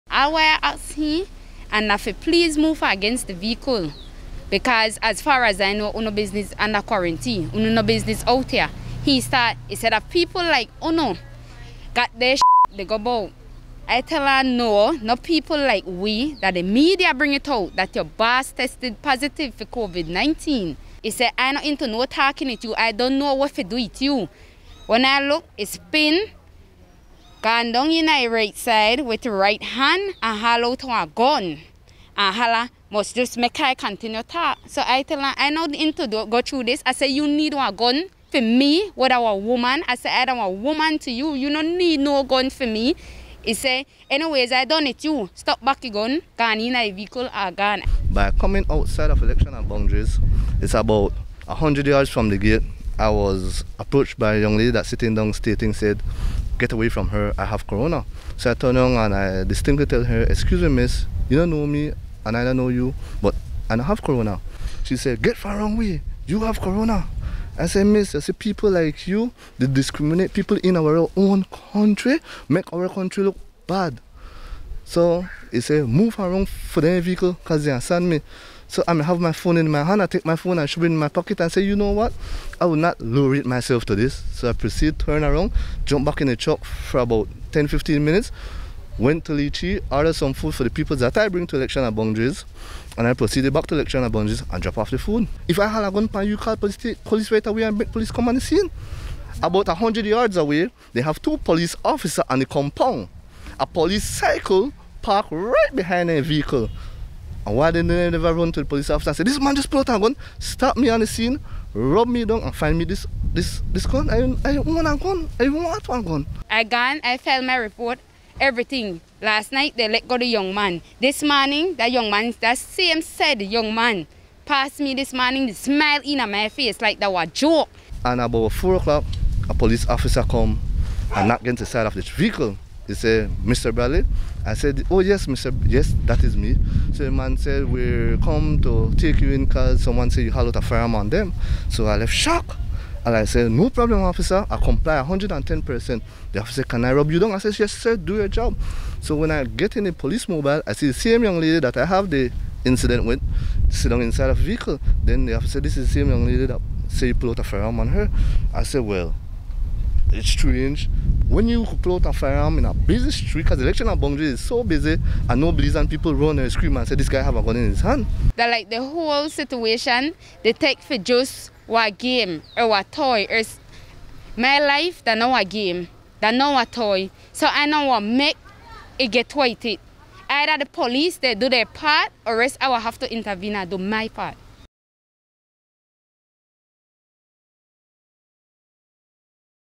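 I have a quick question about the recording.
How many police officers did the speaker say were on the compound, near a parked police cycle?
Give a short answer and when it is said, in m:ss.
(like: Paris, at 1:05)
2, at 1:41.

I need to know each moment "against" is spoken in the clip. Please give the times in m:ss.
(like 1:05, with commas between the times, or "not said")
0:02, 2:11.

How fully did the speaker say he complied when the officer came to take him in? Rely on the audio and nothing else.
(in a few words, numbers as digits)
110%.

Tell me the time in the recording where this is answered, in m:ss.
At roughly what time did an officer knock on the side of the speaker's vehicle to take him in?
2:08.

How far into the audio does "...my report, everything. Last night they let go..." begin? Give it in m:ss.
1:57.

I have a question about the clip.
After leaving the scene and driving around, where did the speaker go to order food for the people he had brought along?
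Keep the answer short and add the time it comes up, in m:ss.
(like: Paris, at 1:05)
Lichi, at 1:29.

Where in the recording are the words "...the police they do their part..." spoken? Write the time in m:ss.
3:00.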